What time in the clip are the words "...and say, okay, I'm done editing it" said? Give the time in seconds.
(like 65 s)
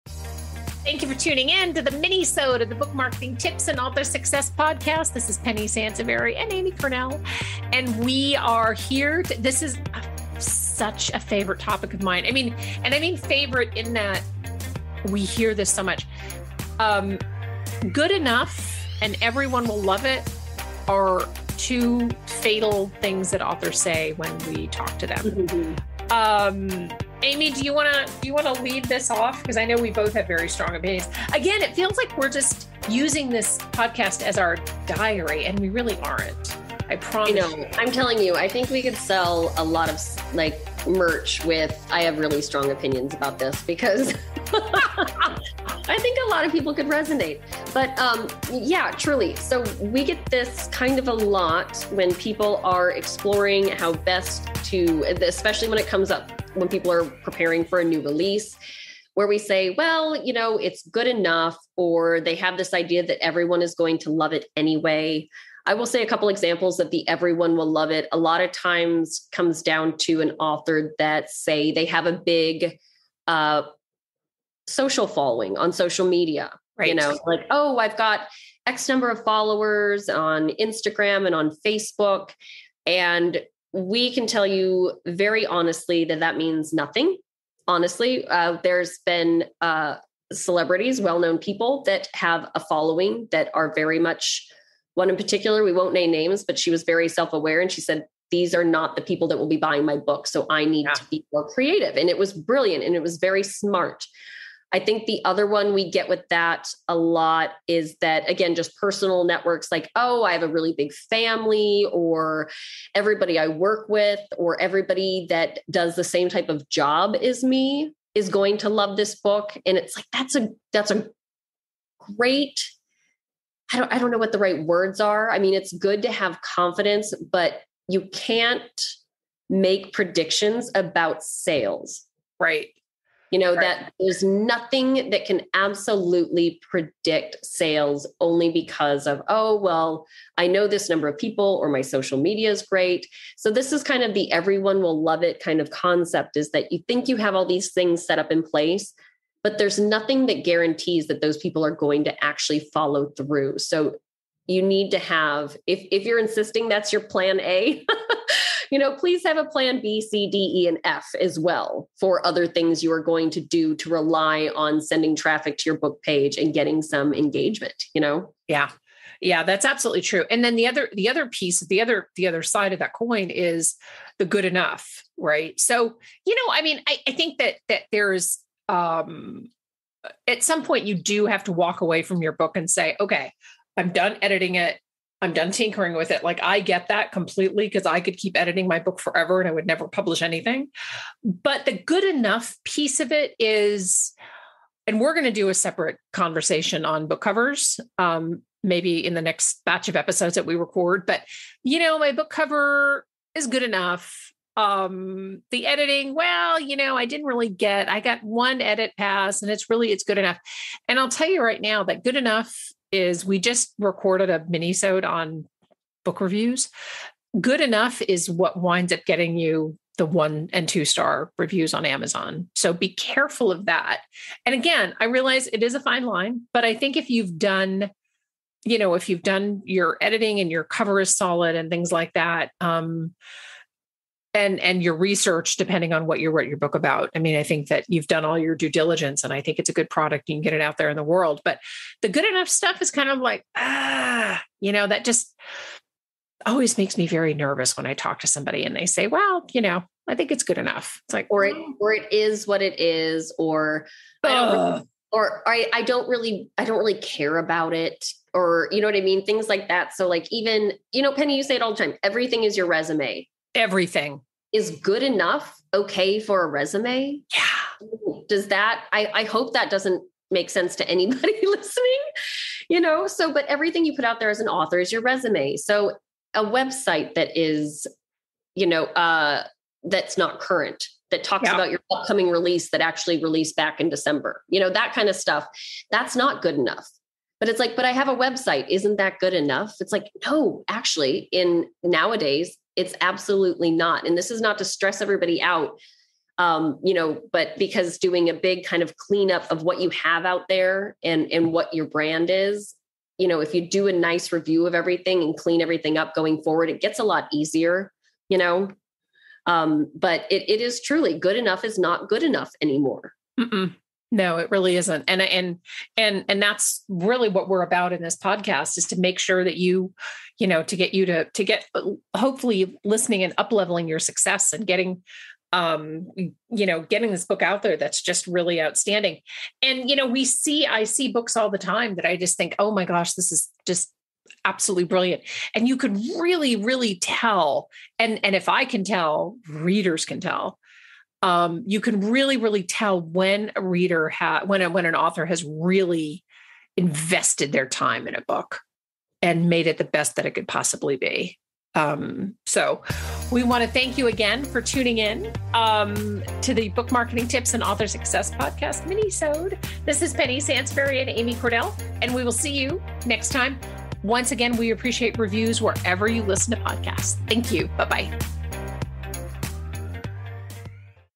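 182 s.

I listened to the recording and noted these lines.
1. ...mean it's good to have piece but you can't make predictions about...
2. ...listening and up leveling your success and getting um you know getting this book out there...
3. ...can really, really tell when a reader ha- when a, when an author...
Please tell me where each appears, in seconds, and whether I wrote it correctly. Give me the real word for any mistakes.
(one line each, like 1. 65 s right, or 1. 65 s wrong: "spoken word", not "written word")
1. 125 s wrong: "confidence", not "piece"
2. 322 s right
3. 341 s right.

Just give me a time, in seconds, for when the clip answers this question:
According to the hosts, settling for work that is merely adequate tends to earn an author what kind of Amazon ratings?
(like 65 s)
220 s.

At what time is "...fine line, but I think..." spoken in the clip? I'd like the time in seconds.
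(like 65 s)
225 s.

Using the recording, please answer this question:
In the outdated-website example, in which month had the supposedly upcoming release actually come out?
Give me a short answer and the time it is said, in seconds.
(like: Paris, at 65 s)
December, at 283 s.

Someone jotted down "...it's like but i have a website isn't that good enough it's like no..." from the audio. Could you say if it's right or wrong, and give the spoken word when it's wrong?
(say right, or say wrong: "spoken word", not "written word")
right.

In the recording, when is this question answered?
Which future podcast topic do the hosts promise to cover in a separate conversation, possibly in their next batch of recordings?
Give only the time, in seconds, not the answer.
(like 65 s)
197 s.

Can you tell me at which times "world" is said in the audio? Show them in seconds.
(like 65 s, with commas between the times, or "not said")
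241 s.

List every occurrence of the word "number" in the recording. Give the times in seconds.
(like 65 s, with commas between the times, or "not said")
78 s, 140 s.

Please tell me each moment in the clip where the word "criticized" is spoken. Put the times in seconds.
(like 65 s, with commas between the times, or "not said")
not said.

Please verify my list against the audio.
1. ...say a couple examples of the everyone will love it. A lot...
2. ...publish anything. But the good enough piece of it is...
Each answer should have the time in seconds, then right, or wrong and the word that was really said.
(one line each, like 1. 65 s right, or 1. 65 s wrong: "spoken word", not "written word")
1. 65 s right
2. 189 s right.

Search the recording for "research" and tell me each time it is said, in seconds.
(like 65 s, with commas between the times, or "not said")
234 s.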